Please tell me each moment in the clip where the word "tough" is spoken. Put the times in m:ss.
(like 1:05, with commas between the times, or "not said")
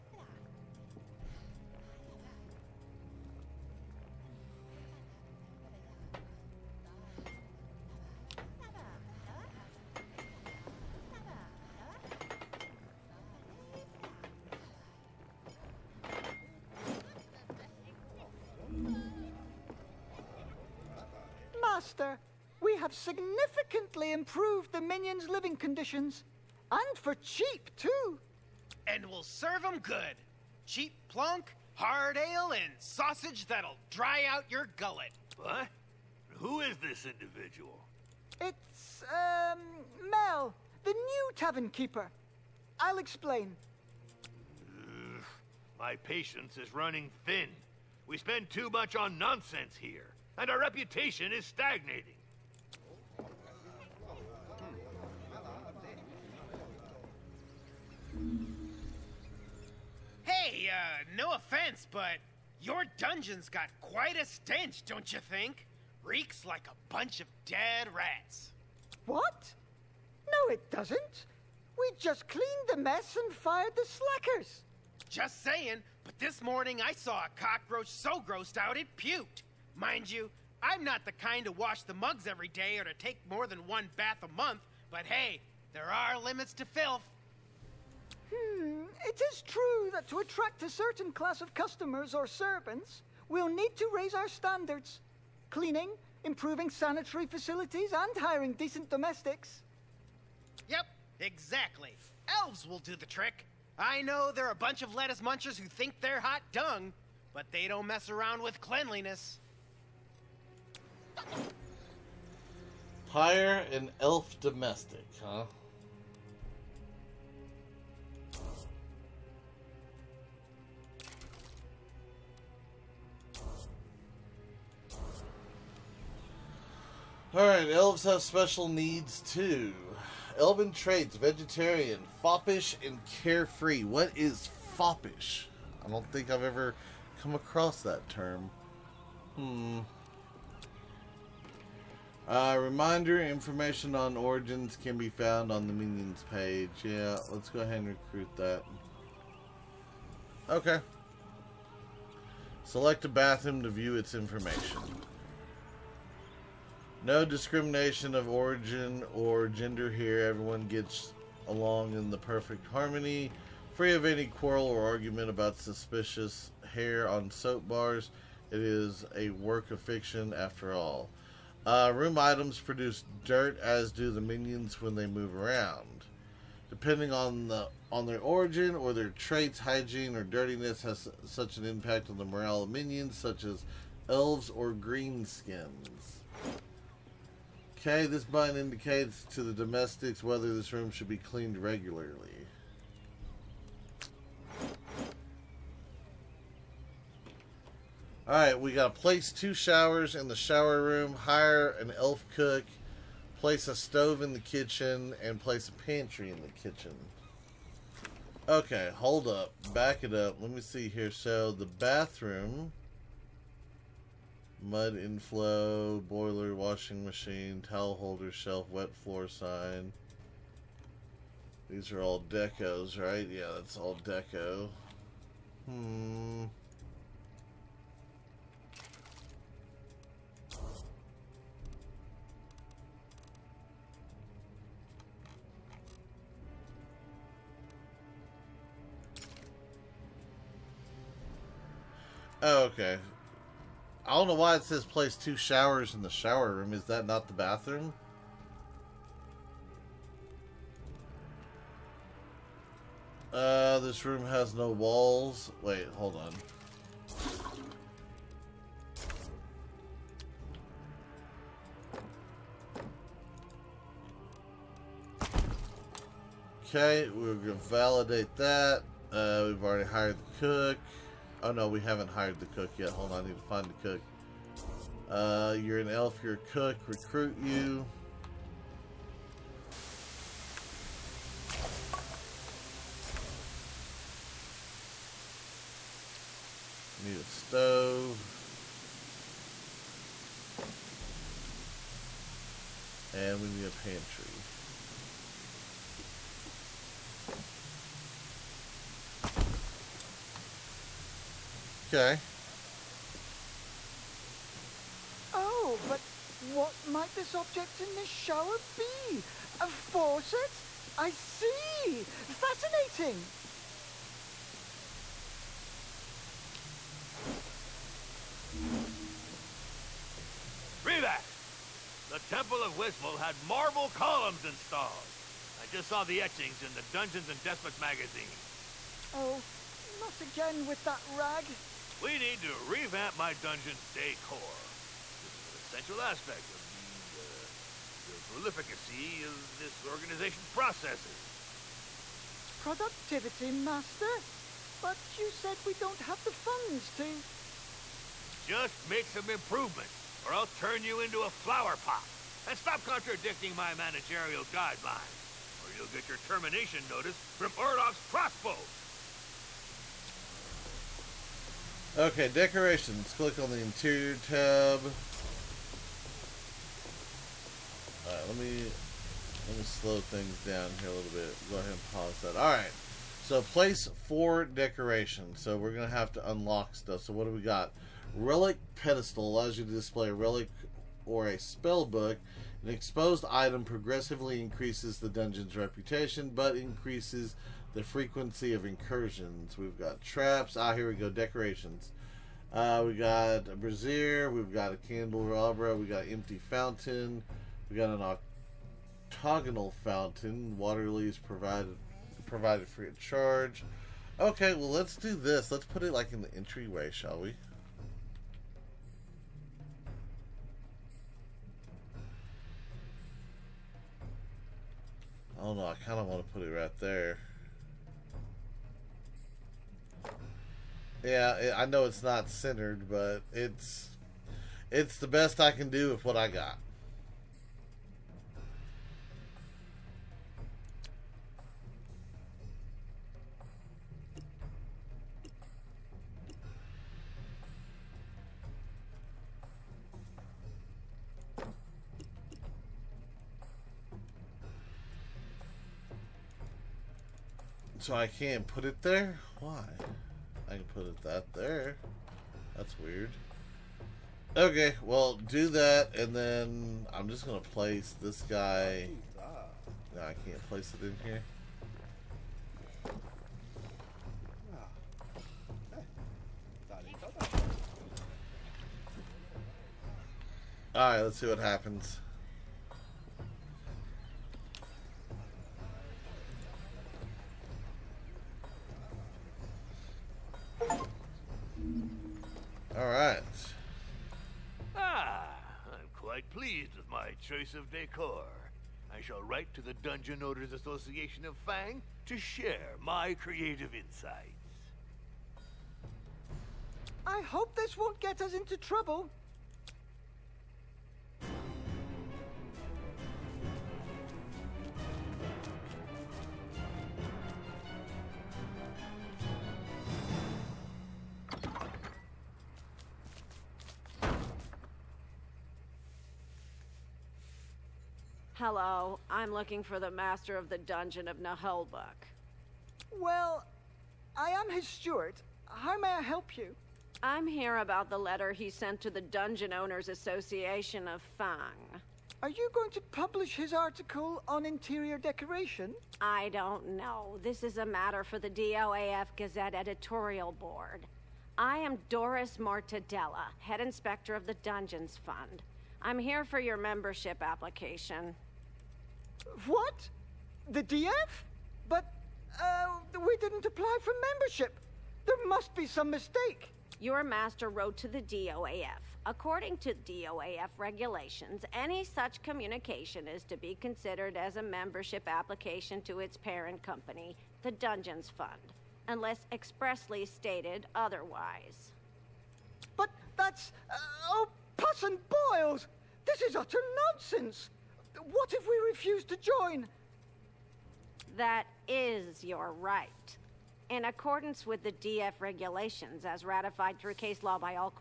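not said.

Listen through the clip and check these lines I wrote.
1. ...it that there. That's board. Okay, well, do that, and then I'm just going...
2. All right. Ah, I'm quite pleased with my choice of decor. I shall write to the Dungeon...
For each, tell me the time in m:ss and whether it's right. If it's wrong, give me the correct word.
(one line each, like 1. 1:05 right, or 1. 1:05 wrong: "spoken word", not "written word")
1. 7:30 wrong: "weird", not "board"
2. 8:02 right.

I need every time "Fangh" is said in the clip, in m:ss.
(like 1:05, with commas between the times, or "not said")
8:11, 8:51.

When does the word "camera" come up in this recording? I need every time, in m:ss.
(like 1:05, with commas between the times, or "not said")
not said.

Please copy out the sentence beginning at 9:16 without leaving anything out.
Your master wrote to the DOAF.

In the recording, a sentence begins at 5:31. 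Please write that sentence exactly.
We need to revamp my dungeon's decor.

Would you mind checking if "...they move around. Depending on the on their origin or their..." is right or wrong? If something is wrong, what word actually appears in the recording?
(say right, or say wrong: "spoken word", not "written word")
right.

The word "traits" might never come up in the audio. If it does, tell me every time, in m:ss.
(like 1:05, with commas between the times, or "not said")
2:10, 2:59.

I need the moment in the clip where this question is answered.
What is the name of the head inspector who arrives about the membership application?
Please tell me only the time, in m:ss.
9:01.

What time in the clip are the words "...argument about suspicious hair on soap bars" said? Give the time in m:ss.
2:44.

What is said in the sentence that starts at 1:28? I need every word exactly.
Hmm, it is true that to attract a certain class of customers or servants, we'll need to raise our standards.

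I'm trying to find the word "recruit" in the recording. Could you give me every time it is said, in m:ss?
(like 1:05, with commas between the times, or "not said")
2:27, 4:36.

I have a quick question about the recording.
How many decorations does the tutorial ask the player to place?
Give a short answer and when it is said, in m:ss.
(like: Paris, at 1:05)
4, at 6:13.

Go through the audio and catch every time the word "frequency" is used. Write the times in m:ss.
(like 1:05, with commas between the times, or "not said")
6:27.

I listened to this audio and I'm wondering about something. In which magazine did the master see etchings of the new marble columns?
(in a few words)
Dungeons and Despots.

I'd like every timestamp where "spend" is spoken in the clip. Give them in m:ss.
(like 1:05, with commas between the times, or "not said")
0:48.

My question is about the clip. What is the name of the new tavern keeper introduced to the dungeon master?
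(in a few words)
Mel.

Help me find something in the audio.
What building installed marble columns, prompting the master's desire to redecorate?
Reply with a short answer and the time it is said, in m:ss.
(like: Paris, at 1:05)
The Temple of Wismal, at 5:22.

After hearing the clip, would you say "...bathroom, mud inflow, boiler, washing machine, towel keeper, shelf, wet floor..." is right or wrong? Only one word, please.
wrong.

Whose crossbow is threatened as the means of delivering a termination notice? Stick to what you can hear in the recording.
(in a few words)
Orloff.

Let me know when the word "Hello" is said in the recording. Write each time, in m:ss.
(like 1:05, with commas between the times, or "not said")
8:38.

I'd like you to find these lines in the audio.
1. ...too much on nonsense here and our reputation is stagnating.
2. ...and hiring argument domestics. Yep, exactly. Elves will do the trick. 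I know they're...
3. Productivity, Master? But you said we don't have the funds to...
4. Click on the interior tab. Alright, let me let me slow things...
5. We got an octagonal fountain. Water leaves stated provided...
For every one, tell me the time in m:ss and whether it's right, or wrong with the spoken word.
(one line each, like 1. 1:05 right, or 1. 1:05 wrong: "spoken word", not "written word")
1. 0:48 right
2. 1:37 wrong: "decent", not "argument"
3. 5:42 right
4. 6:03 right
5. 6:37 wrong: "provided", not "stated".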